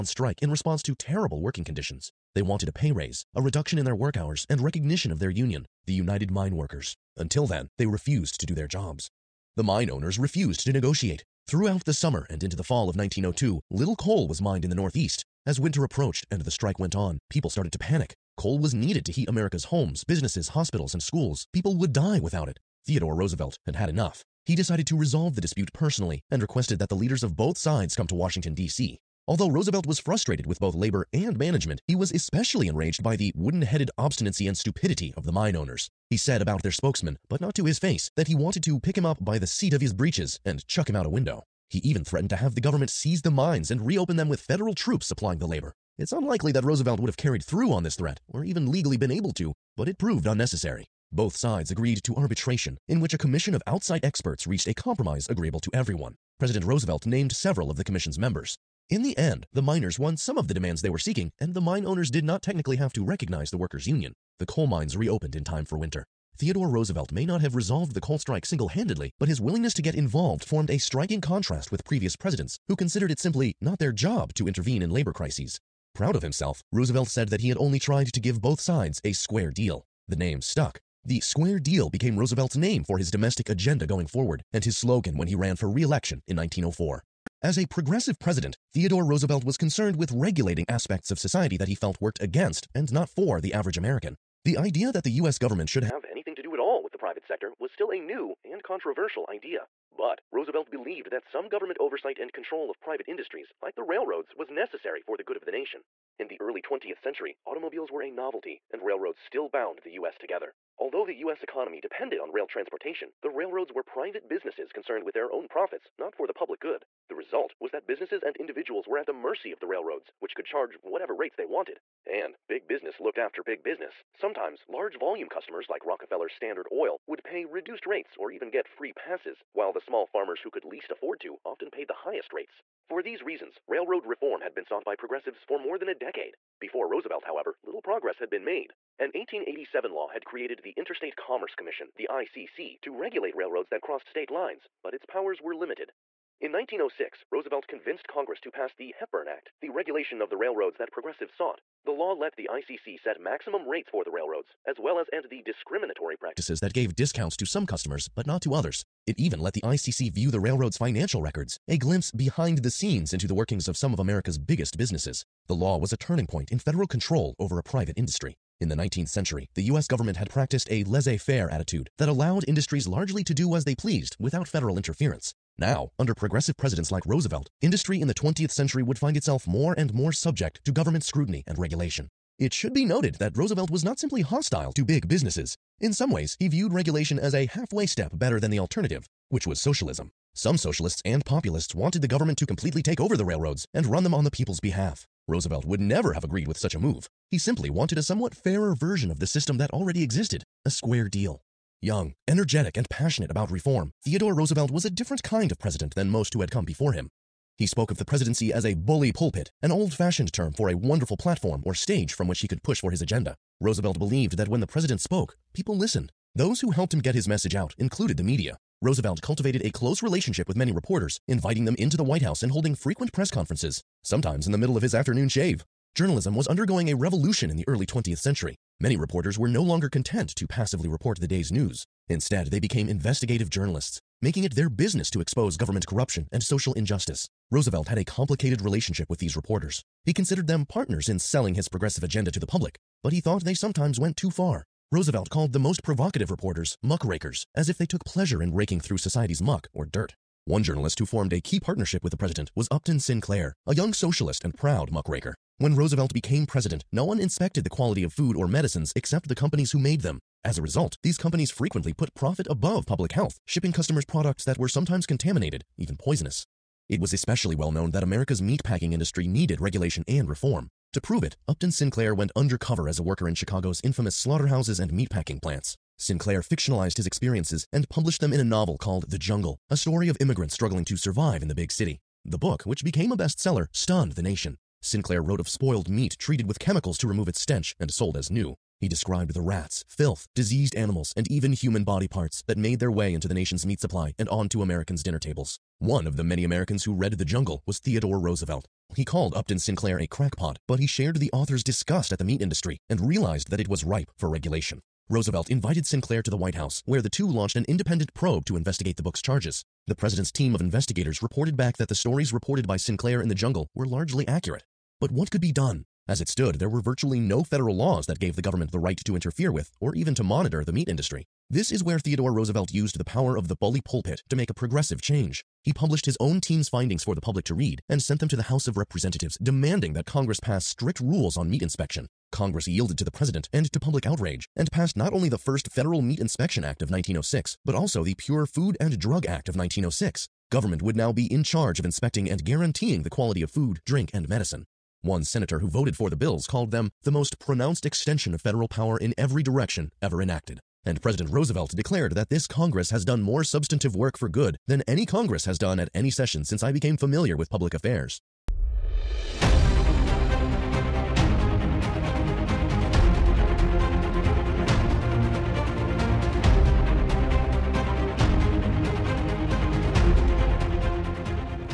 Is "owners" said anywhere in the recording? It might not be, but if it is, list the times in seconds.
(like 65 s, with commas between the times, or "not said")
9 s, 35 s, 61 s.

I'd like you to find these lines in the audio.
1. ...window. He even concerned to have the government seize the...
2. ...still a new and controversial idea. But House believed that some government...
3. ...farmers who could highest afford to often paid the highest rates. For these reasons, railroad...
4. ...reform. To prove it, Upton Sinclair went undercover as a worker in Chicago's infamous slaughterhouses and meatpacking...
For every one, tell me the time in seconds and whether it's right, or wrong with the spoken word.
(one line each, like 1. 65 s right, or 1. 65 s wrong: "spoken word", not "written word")
1. 41 s wrong: "threatened", not "concerned"
2. 97 s wrong: "Roosevelt", not "House"
3. 130 s wrong: "least", not "highest"
4. 270 s right.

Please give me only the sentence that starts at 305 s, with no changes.
Roosevelt invited Sinclair to the White House, where the two launched an independent probe to investigate the book's charges.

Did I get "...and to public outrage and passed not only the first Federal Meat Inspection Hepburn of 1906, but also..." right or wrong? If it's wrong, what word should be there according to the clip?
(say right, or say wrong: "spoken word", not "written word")
wrong: "Act", not "Hepburn".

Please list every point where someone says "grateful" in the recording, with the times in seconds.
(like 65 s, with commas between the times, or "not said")
not said.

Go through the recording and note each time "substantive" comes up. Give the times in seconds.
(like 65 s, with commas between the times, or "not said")
353 s.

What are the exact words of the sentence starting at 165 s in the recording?
The law was a turning point in federal control over a private industry.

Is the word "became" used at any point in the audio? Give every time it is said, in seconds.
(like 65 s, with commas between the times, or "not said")
81 s, 232 s, 256 s, 282 s, 356 s.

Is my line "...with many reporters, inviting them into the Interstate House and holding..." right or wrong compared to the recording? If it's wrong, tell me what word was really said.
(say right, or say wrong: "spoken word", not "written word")
wrong: "White", not "Interstate".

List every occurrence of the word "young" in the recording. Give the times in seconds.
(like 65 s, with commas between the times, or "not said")
201 s, 253 s.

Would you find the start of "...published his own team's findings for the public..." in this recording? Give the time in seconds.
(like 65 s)
325 s.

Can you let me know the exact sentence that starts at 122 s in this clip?
And big business looked after big business.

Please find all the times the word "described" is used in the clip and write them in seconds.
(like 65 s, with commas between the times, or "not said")
288 s.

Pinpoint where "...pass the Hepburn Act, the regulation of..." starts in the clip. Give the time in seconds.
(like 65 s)
148 s.